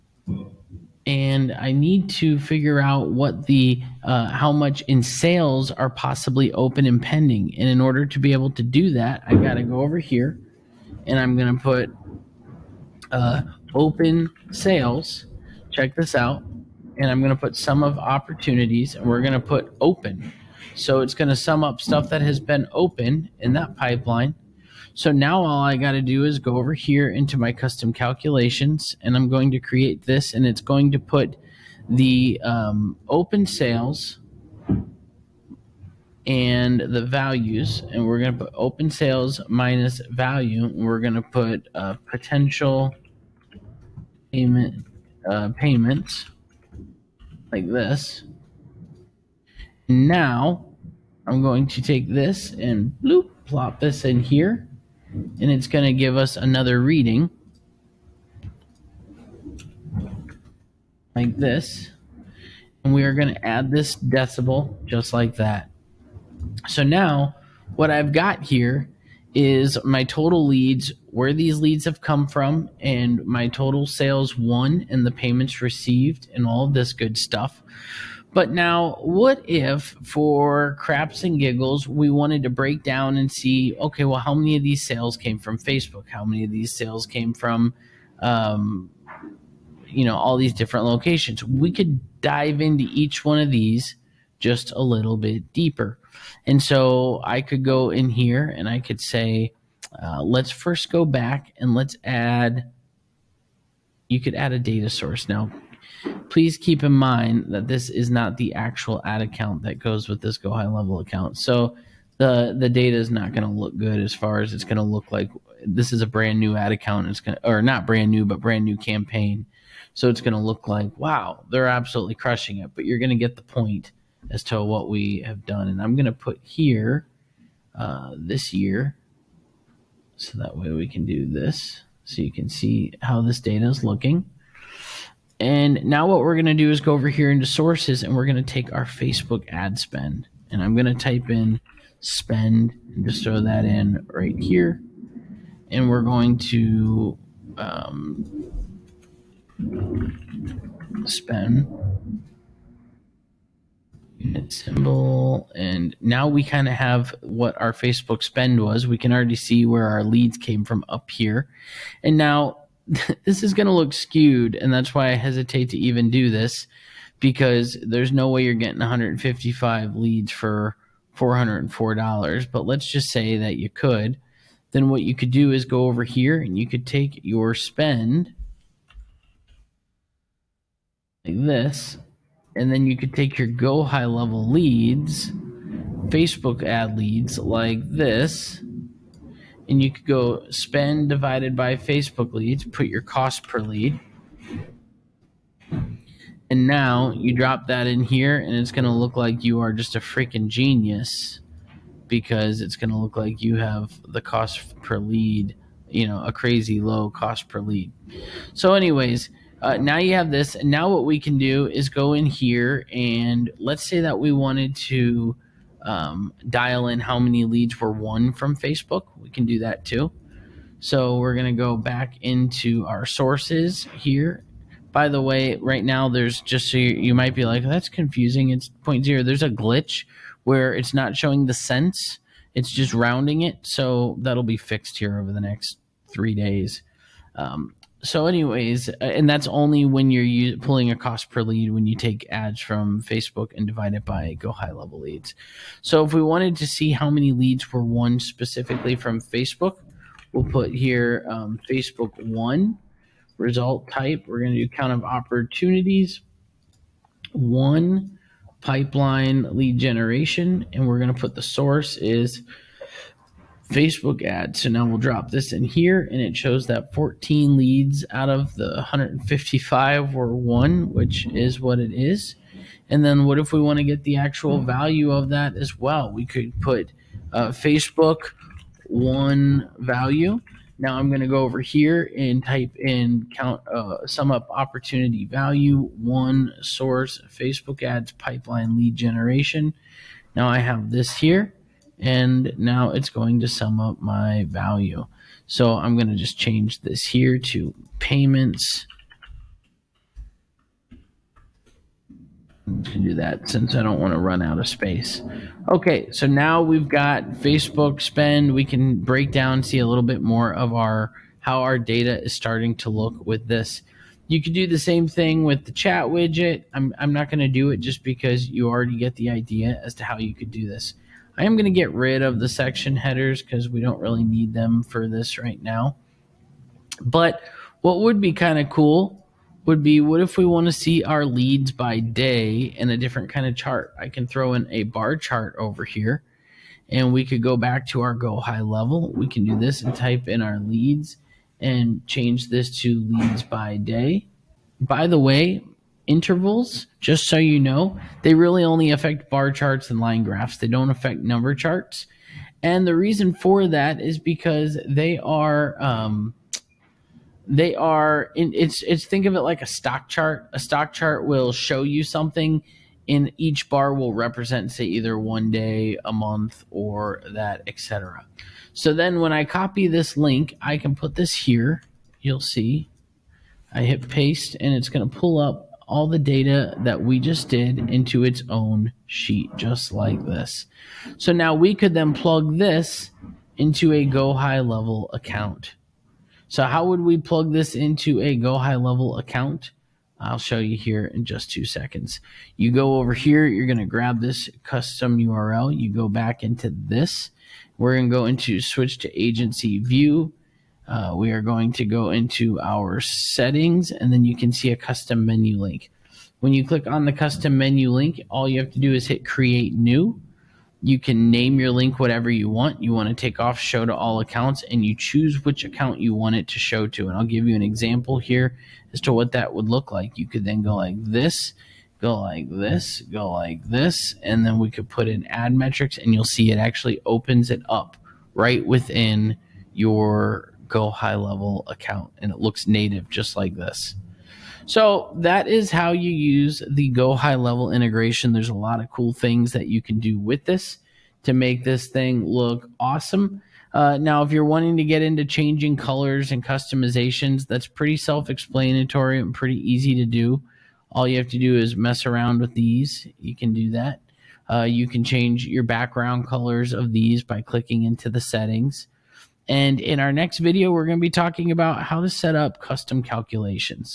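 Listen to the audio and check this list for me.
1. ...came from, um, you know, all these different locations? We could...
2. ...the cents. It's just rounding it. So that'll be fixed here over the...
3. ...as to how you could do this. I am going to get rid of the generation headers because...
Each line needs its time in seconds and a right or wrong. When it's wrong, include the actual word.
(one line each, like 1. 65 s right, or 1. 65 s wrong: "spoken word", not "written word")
1. 87 s right
2. 231 s right
3. 319 s wrong: "section", not "generation".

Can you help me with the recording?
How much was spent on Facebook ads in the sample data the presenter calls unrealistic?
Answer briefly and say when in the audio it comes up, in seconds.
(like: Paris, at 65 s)
$404, at 171 s.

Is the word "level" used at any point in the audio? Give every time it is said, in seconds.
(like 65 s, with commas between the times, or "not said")
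110 s, 184 s, 244 s, 338 s, 384 s, 388 s, 431 s, 437 s.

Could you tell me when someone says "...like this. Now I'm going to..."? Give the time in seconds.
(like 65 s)
47 s.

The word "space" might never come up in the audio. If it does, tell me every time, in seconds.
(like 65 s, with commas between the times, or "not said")
304 s.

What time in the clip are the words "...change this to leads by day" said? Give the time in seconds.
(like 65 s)
342 s.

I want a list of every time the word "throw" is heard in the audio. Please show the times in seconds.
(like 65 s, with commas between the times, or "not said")
143 s, 334 s.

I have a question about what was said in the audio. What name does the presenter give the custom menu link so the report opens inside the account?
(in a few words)
Ad metrics.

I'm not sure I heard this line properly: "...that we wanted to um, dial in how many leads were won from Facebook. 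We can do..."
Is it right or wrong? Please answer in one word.
right.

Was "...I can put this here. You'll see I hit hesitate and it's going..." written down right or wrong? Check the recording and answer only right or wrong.
wrong.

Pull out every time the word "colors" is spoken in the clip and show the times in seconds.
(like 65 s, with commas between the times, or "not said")
445 s, 456 s.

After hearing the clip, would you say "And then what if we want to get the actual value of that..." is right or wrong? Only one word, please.
right.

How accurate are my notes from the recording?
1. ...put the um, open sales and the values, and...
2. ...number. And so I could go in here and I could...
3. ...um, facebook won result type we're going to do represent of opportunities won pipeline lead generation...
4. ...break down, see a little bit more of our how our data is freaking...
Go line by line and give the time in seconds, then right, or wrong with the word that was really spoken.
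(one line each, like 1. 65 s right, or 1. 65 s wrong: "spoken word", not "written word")
1. 30 s right
2. 95 s wrong: "deeper", not "number"
3. 251 s wrong: "count", not "represent"
4. 309 s wrong: "starting", not "freaking".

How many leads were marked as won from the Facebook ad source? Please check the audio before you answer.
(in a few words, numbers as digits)
14.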